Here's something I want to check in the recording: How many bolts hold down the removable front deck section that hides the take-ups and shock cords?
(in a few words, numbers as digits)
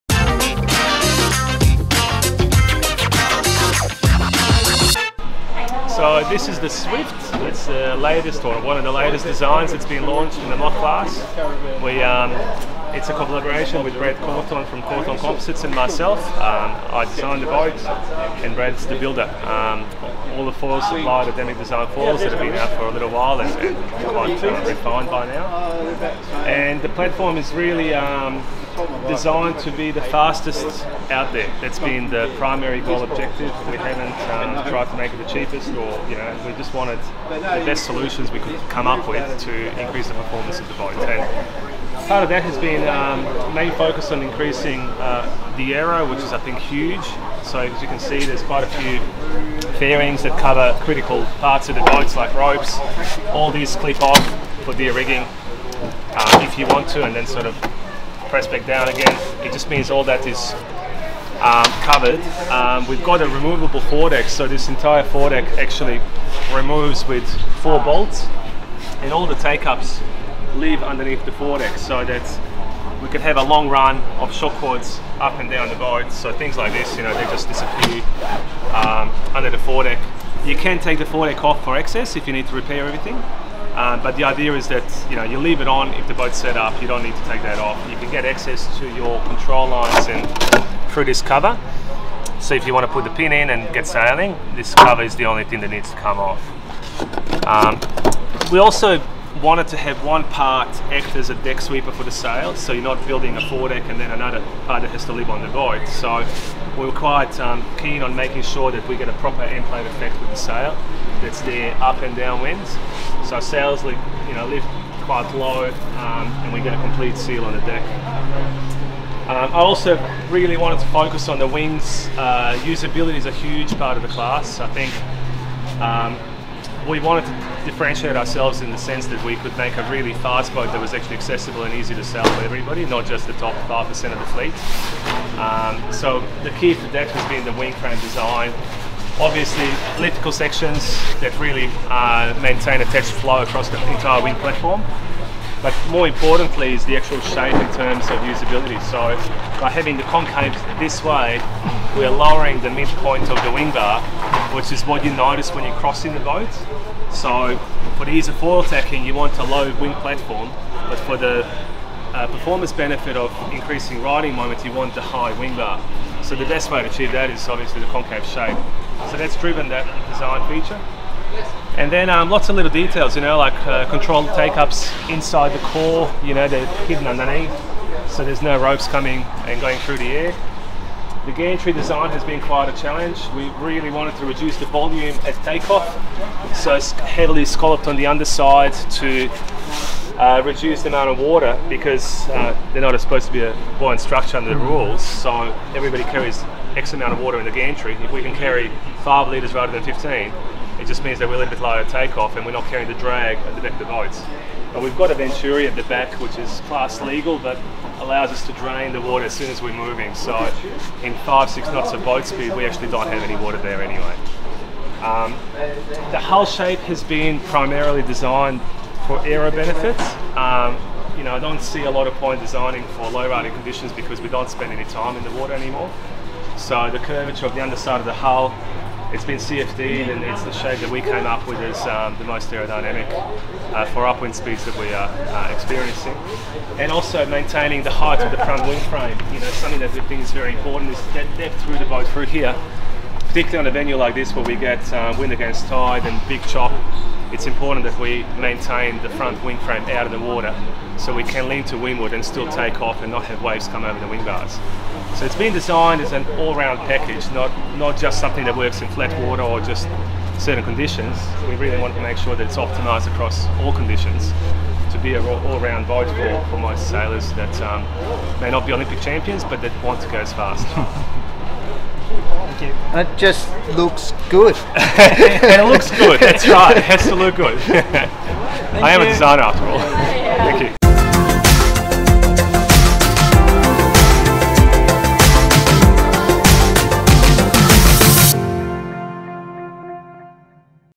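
4.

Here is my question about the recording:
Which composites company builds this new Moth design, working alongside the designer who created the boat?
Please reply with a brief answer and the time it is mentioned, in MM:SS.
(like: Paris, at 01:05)
Cawthon Composites, at 00:14.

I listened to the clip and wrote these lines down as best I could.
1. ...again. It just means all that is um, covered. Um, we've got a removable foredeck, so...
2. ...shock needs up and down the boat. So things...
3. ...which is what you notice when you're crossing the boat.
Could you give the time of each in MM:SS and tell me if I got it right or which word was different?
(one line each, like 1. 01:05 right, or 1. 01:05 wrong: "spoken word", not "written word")
1. 00:58 right
2. 01:14 wrong: "cords", not "needs"
3. 02:34 right.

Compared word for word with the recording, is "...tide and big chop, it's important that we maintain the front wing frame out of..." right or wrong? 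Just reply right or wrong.
right.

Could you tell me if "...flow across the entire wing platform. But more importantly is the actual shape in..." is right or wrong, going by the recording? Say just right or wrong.
right.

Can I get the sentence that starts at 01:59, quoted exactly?
Um, I also really wanted to focus on the wings.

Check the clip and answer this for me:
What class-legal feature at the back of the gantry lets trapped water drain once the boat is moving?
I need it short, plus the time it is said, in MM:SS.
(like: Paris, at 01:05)
A venturi, at 03:25.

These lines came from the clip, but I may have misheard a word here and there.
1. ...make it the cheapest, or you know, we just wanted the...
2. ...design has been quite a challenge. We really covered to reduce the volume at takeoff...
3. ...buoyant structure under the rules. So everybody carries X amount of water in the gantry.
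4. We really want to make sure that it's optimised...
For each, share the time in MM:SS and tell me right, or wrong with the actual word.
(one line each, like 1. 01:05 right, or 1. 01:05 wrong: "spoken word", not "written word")
1. 00:34 right
2. 03:01 wrong: "wanted", not "covered"
3. 03:13 right
4. 04:21 right.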